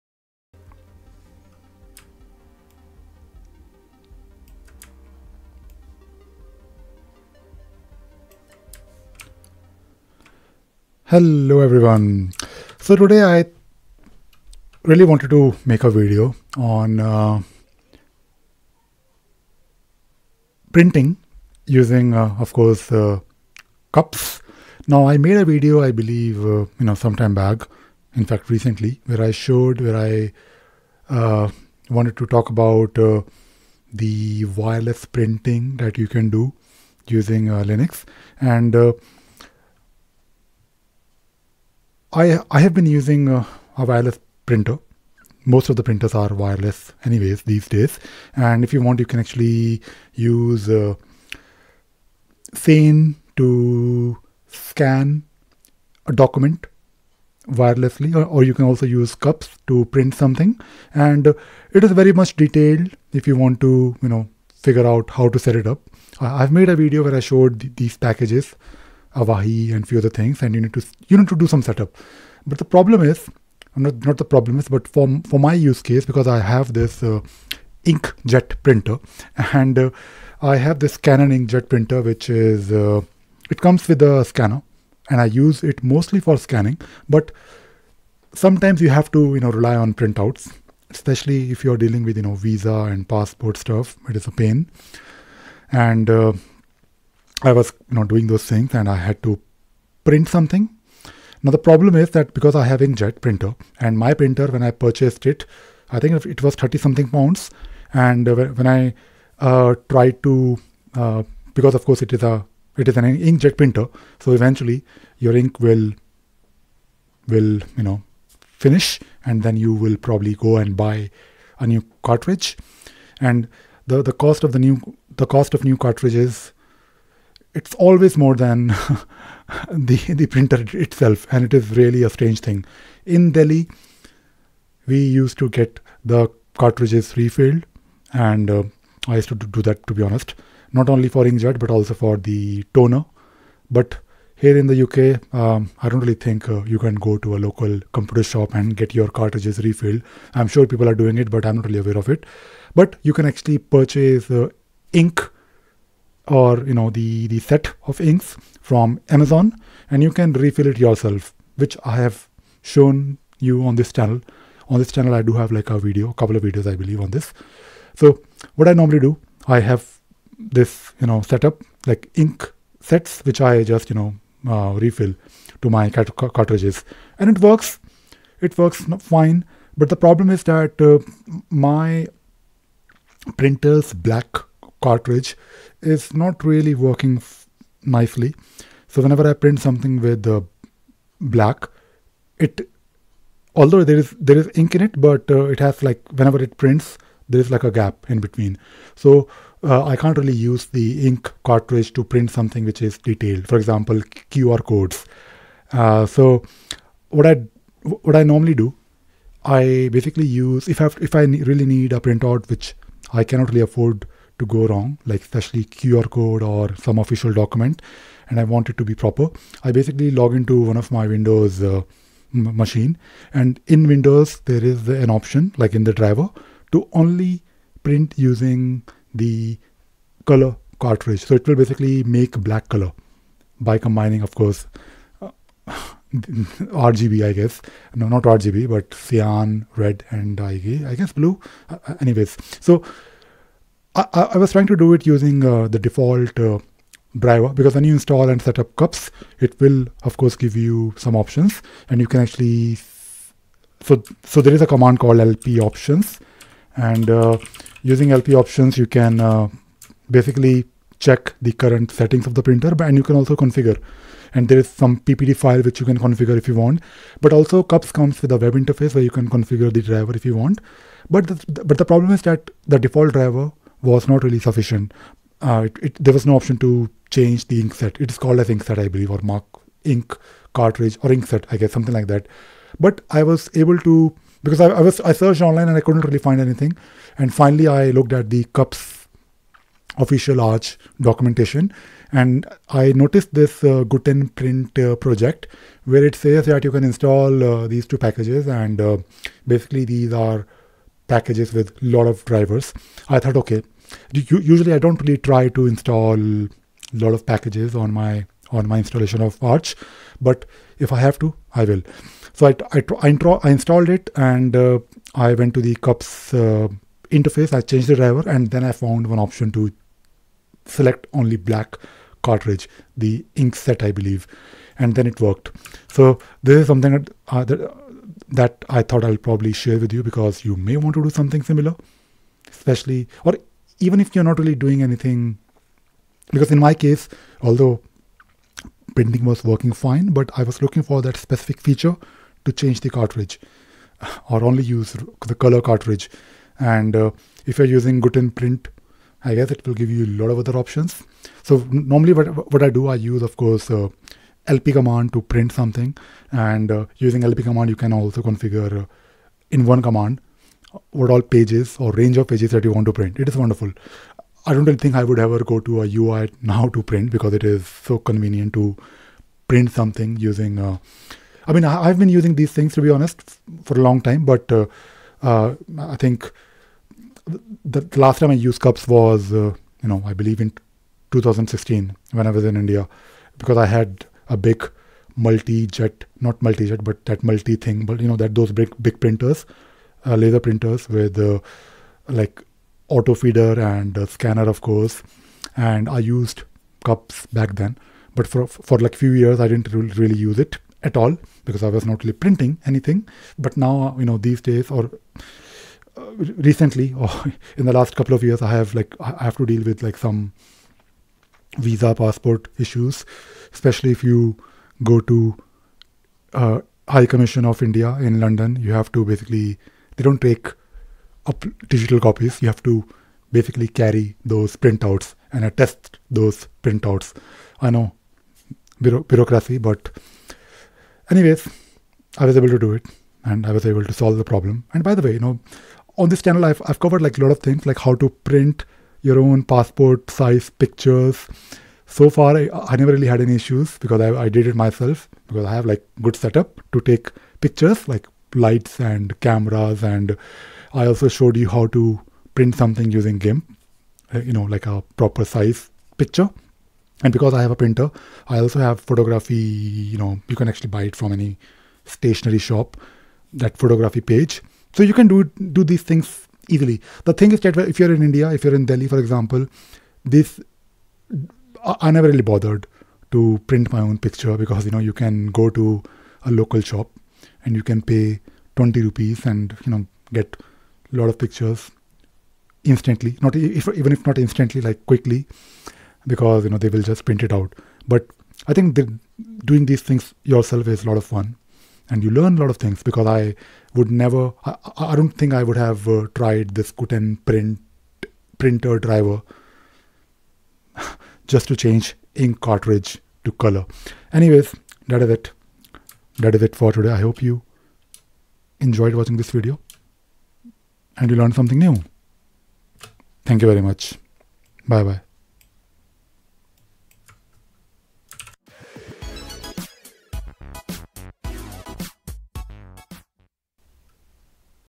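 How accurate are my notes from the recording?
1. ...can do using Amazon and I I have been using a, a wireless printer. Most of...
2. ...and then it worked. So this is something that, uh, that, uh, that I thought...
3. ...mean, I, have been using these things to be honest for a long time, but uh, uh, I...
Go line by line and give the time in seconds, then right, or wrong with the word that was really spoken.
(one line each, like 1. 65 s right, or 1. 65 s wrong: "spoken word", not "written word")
1. 36 s wrong: "Linux", not "Amazon"
2. 324 s right
3. 371 s right.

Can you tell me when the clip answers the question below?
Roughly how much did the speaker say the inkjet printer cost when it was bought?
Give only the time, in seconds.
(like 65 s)
106 s.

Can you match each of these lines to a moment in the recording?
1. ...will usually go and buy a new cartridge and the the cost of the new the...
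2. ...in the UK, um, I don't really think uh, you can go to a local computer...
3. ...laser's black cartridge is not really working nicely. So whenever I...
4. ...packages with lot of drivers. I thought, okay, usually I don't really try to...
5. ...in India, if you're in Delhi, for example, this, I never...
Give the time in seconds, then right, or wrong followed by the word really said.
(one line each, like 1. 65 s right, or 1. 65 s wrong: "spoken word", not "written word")
1. 119 s wrong: "probably", not "usually"
2. 144 s right
3. 183 s wrong: "printer", not "laser"
4. 301 s right
5. 467 s right.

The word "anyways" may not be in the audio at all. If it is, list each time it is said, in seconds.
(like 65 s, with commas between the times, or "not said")
47 s, 242 s, 431 s, 504 s.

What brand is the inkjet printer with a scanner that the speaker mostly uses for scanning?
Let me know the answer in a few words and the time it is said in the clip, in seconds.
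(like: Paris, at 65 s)
Canon, at 80 s.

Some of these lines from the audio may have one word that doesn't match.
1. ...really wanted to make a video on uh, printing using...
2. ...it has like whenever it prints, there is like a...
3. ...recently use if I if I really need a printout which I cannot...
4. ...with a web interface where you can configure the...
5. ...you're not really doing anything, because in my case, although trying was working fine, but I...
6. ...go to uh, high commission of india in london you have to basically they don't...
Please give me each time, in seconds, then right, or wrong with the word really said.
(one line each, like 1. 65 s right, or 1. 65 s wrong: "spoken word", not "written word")
1. 14 s right
2. 195 s right
3. 209 s wrong: "basically", not "recently"
4. 268 s right
5. 334 s wrong: "printing", not "trying"
6. 414 s right.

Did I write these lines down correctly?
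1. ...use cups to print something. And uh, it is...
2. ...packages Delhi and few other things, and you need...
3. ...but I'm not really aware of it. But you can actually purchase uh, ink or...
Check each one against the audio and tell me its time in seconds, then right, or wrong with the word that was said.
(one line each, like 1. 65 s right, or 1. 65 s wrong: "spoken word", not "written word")
1. 58 s right
2. 67 s wrong: "Avahi", not "Delhi"
3. 151 s right.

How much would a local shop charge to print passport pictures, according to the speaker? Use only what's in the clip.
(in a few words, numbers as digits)
20 rupees.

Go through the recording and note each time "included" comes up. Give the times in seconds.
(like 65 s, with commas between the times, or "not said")
not said.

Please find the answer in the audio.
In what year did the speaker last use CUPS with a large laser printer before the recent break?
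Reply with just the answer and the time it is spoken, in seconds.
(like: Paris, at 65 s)
2016, at 381 s.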